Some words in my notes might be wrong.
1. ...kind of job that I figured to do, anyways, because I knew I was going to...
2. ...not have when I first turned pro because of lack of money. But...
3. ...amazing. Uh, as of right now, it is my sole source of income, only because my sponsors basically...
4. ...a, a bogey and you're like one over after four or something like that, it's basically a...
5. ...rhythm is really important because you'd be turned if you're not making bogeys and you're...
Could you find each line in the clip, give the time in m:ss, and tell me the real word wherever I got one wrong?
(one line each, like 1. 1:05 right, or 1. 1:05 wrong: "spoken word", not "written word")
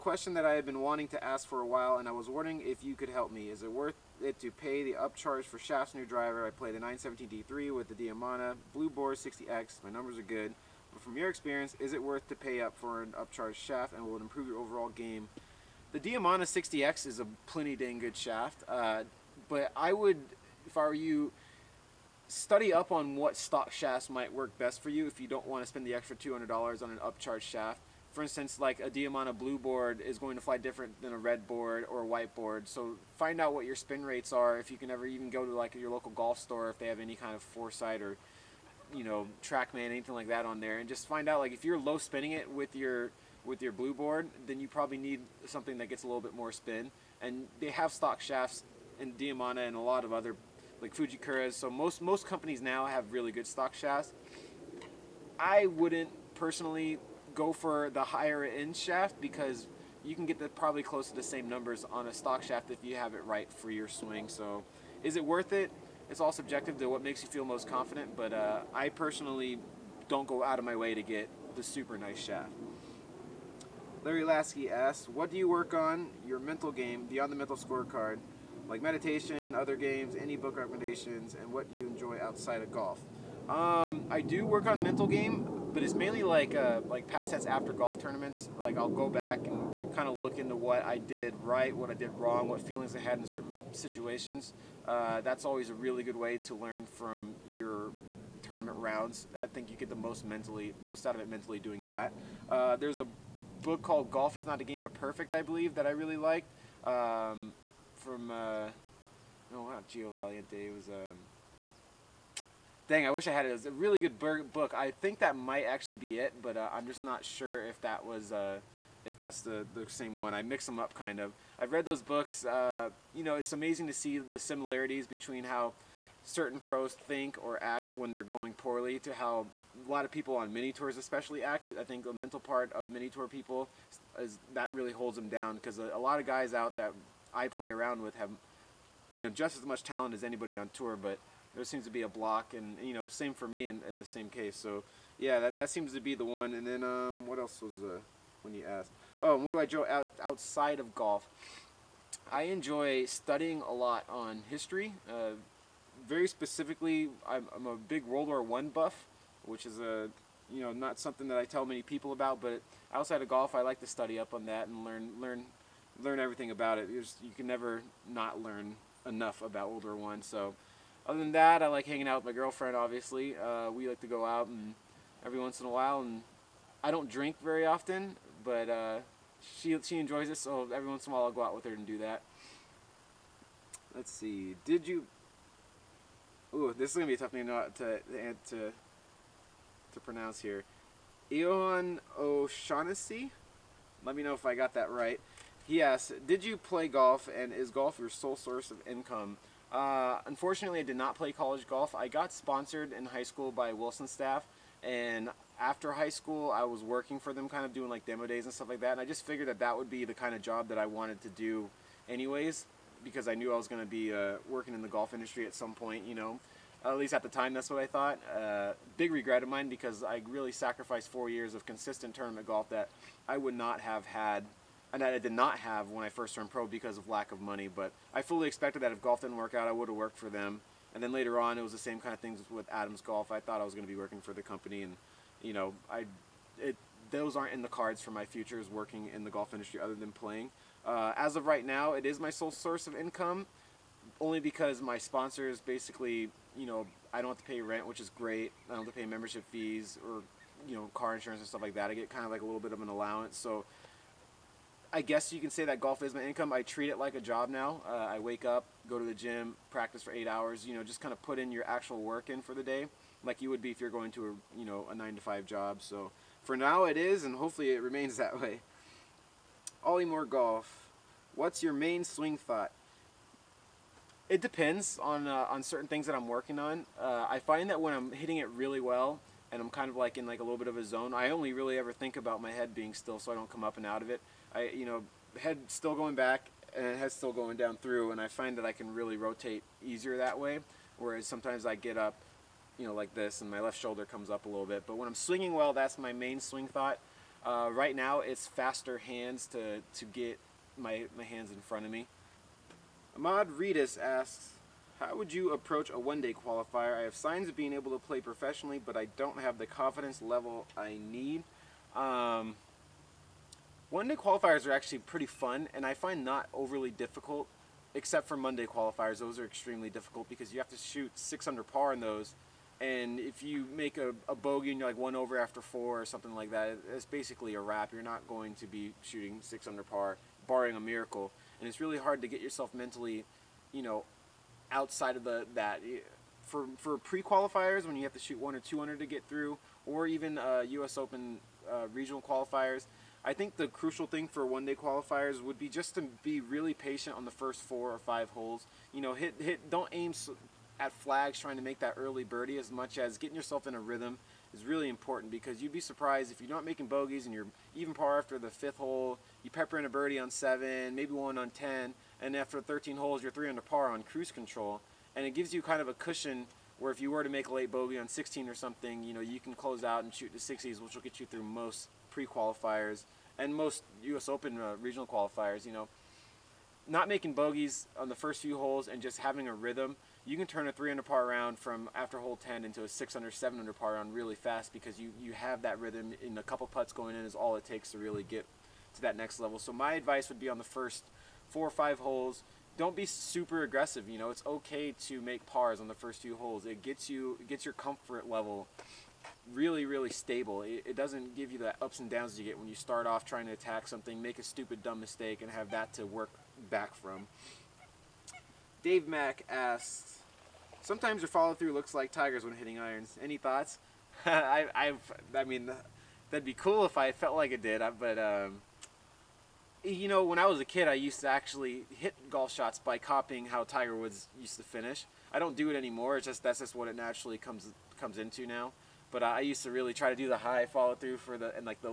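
1. 3:30 wrong: "wanted", not "figured"
2. 3:45 right
3. 4:00 wrong: "playing", not "amazing"
4. 5:23 right
5. 5:53 wrong: "surprised", not "turned".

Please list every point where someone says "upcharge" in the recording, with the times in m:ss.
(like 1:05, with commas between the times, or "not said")
0:04, 0:13, 0:26.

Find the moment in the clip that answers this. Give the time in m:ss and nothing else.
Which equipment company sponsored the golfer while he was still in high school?
3:23.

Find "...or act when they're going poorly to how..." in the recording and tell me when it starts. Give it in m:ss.
2:07.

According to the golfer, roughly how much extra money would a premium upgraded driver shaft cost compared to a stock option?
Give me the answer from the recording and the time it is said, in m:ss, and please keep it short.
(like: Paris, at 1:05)
$200, at 0:26.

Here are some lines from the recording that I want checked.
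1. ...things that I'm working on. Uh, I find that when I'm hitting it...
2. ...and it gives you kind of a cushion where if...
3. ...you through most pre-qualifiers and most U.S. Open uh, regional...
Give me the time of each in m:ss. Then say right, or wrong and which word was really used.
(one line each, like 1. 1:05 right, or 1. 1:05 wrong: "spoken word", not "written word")
1. 4:35 right
2. 6:05 right
3. 6:11 right.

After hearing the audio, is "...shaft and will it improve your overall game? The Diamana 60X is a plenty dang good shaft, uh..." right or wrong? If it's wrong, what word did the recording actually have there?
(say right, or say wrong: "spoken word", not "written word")
right.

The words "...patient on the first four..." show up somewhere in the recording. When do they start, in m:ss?
5:46.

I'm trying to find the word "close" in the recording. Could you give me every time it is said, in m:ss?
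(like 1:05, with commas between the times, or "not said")
1:00, 6:09.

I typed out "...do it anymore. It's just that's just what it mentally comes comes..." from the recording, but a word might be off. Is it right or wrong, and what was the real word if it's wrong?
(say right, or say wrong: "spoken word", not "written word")
wrong: "naturally", not "mentally".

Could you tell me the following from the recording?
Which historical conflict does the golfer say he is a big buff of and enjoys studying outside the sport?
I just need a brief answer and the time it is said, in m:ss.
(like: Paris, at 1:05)
World War One, at 2:38.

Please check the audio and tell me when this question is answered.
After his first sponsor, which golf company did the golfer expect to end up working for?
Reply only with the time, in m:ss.
3:52.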